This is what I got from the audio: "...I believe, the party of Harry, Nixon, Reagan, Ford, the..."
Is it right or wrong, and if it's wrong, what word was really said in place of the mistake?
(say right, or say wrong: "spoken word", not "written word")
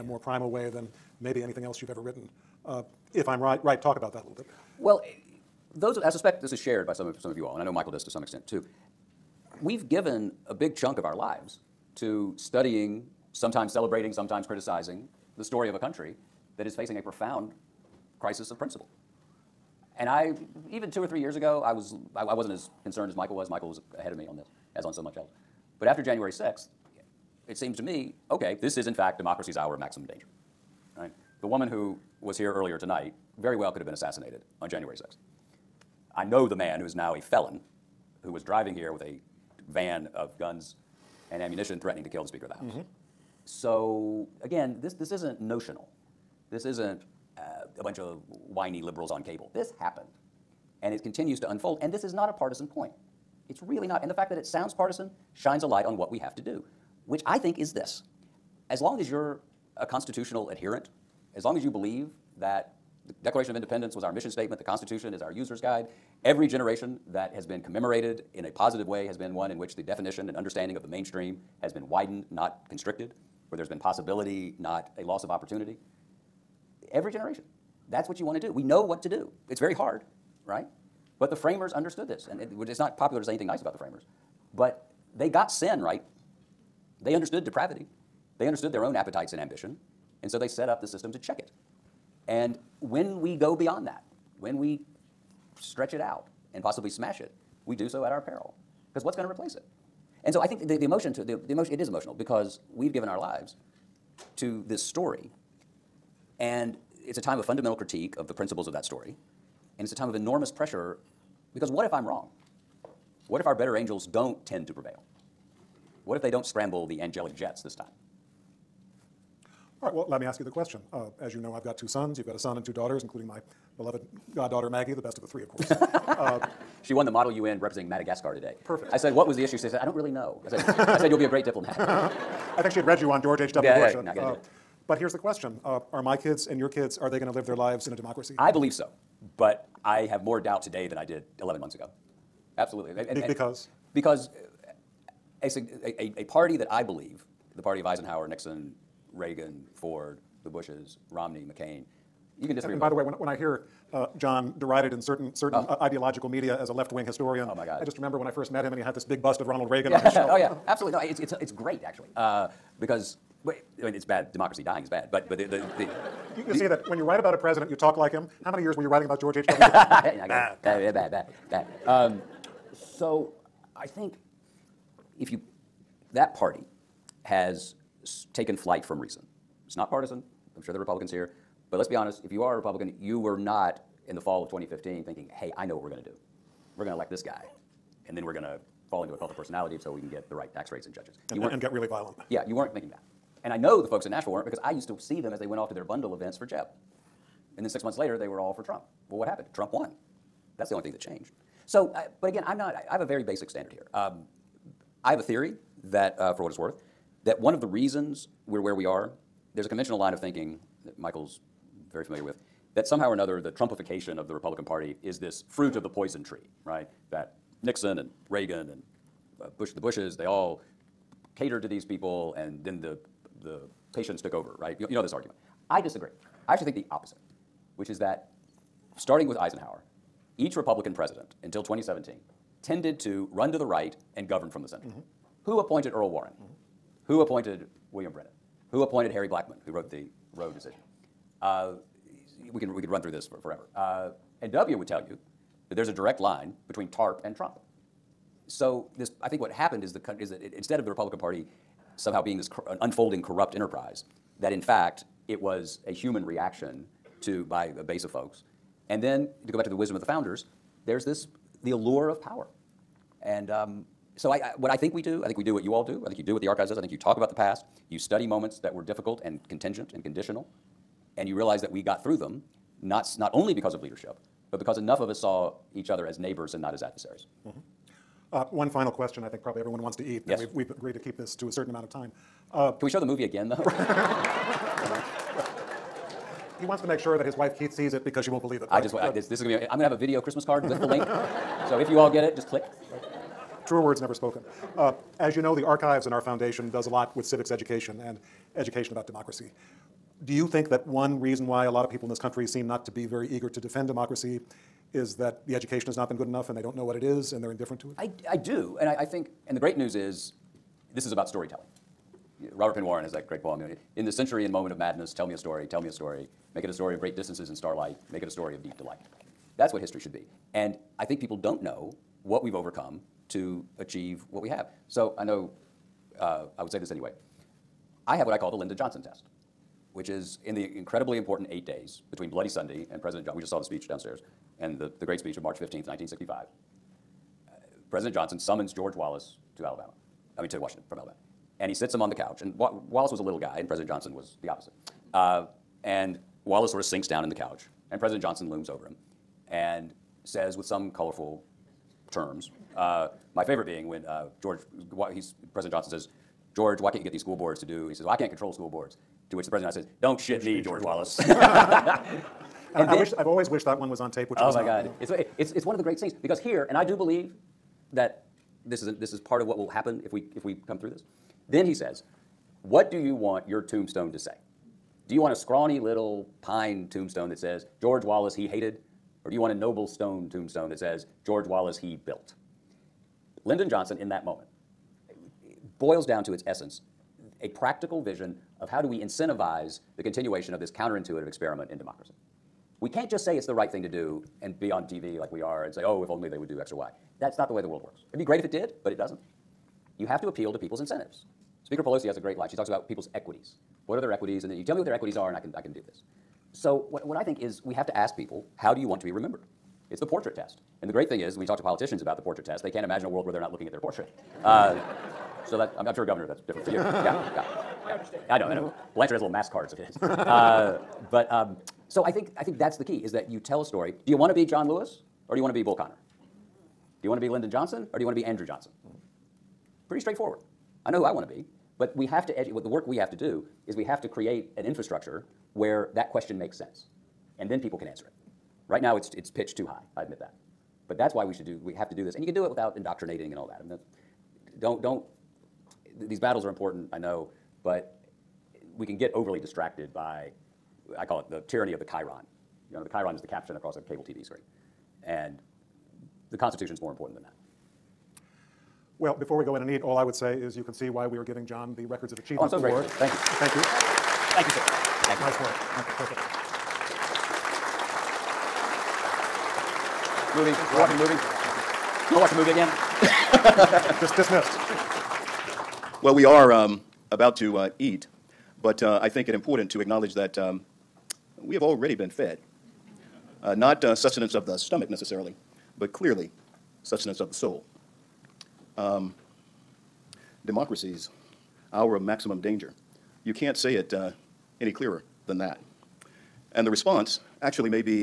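wrong: "Eisenhower", not "Harry".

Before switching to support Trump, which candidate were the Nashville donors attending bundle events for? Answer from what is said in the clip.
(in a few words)
Jeb.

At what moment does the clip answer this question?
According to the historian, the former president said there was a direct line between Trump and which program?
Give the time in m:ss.
4:06.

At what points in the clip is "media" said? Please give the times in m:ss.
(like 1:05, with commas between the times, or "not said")
2:36.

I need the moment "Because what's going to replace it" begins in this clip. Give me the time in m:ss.
1:38.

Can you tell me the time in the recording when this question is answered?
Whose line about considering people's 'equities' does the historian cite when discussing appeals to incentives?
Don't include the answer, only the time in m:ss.
6:41.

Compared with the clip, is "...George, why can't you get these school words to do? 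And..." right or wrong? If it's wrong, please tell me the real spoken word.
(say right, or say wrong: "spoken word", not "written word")
wrong: "boards", not "words".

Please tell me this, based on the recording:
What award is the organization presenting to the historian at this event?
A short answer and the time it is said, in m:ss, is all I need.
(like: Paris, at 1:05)
Records of Achievement Award, at 7:41.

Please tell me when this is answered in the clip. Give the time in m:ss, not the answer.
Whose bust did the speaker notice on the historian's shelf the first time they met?
2:39.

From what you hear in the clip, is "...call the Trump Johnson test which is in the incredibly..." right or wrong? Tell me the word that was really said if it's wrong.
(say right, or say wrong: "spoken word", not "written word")
wrong: "Lyndon", not "Trump".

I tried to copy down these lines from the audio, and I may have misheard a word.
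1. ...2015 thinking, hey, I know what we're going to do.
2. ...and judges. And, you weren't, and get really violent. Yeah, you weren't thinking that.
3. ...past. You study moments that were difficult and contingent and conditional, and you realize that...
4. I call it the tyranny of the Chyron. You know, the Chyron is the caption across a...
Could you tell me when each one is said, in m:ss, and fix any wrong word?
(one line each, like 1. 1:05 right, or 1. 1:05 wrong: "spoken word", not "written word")
1. 3:04 right
2. 3:10 right
3. 4:27 right
4. 7:30 right.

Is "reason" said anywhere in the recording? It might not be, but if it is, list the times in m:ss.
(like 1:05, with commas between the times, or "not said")
2:58, 3:27, 5:01.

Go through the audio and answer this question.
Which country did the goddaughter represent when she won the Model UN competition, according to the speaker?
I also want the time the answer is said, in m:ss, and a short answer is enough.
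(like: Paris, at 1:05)
Madagascar, at 2:07.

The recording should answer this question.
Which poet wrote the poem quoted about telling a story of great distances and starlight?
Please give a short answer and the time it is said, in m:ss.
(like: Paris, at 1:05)
Robert Penn Warren, at 5:12.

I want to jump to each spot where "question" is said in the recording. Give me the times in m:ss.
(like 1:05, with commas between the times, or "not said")
2:00, 2:15, 4:38, 7:16.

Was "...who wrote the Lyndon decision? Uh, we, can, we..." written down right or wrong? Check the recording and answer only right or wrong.
wrong.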